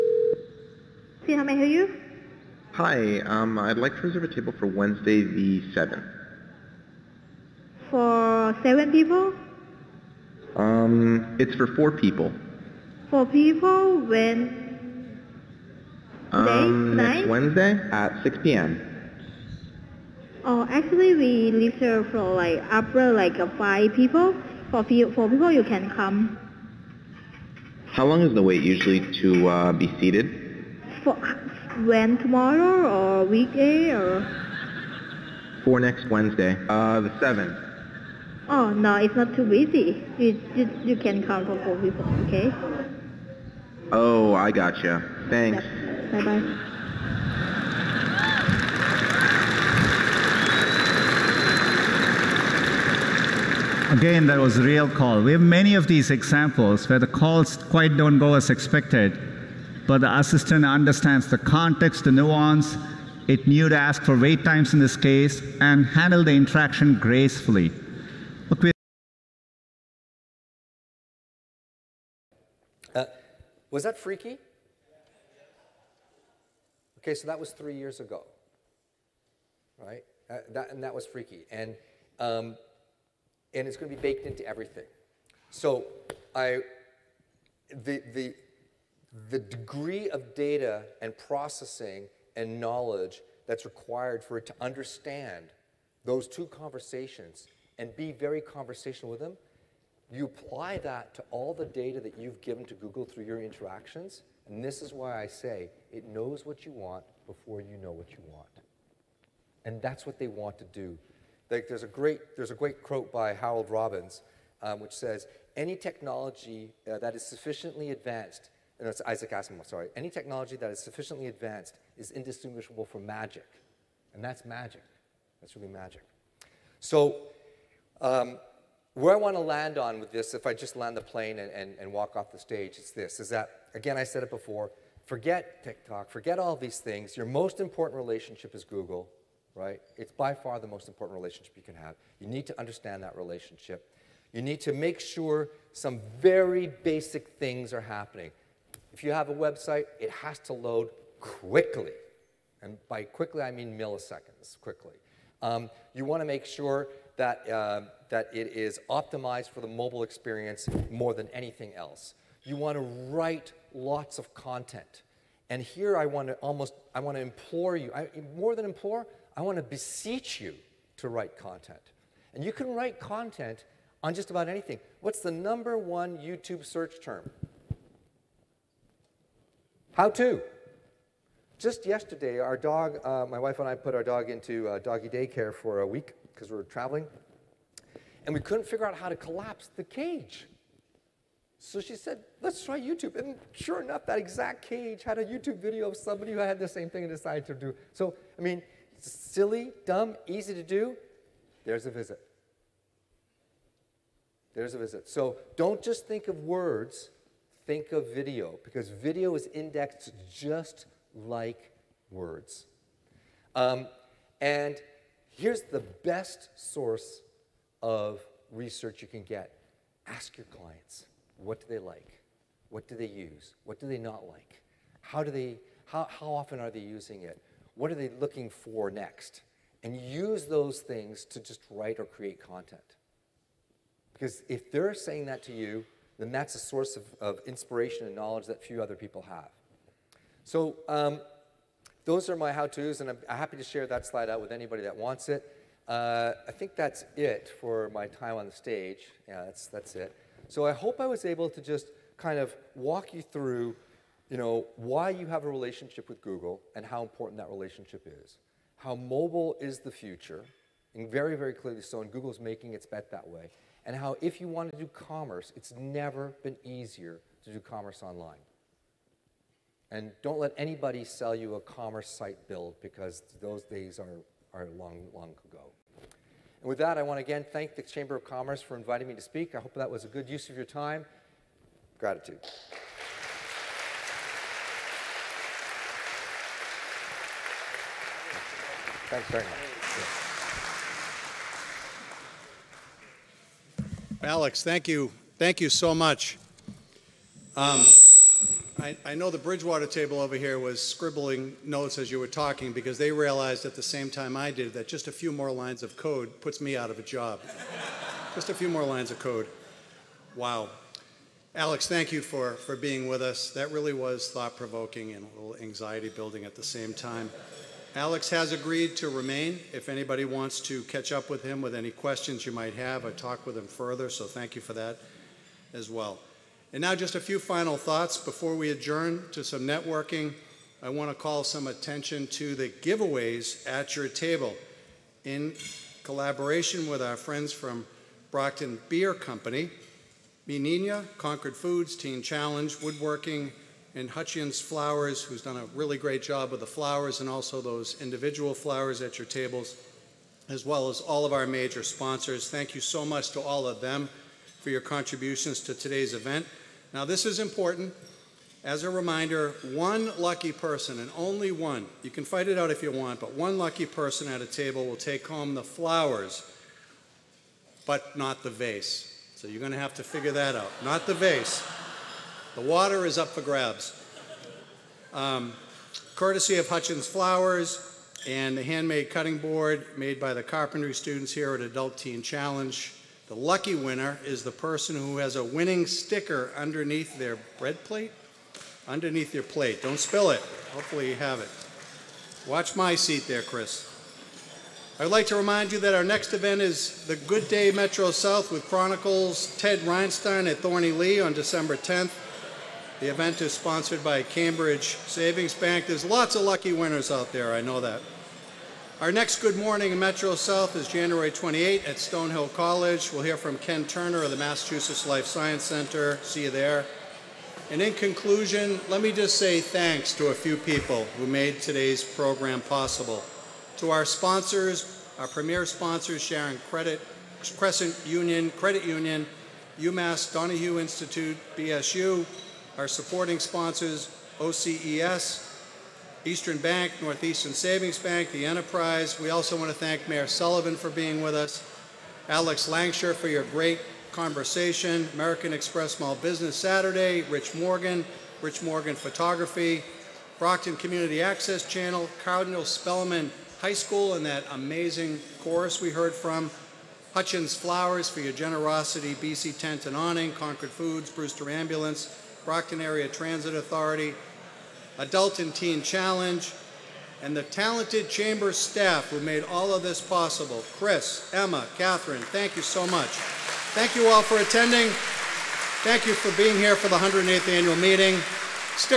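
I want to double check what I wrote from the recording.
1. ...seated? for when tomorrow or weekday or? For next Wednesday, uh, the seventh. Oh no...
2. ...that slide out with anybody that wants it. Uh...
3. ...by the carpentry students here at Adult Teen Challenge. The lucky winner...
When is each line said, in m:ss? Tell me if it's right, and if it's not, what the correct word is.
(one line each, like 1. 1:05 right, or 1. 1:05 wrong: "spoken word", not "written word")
1. 0:29 right
2. 4:03 right
3. 6:20 right.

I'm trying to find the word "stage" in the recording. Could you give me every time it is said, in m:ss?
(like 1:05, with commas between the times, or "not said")
2:12, 4:08.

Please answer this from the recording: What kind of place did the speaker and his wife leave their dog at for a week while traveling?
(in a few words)
Doggy daycare.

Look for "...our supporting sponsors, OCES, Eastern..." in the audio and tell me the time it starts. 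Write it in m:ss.
7:12.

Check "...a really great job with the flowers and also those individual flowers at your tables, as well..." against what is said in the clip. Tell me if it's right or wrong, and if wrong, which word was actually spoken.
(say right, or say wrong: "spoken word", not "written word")
right.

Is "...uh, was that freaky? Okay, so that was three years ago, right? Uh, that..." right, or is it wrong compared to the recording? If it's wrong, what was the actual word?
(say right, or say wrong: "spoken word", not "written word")
right.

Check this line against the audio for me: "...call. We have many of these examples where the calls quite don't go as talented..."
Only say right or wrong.
wrong.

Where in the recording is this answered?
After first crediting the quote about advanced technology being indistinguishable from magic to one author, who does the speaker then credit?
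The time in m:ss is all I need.
1:59.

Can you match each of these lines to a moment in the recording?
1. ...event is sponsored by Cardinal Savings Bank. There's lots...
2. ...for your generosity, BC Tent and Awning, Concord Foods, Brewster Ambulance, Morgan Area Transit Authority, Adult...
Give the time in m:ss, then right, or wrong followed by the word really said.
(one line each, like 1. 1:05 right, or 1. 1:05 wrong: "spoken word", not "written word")
1. 6:43 wrong: "Cambridge", not "Cardinal"
2. 7:38 wrong: "Brockton", not "Morgan".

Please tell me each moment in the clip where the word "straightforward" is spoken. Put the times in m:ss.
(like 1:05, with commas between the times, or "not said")
not said.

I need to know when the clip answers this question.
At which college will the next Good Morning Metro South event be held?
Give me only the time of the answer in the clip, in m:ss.
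6:51.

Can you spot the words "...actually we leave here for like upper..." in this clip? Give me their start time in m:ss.
0:20.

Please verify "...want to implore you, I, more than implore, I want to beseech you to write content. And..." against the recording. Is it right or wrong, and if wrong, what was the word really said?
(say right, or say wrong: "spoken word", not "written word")
right.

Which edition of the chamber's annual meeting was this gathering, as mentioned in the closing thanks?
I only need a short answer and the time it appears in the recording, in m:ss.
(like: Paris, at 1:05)
108th, at 7:56.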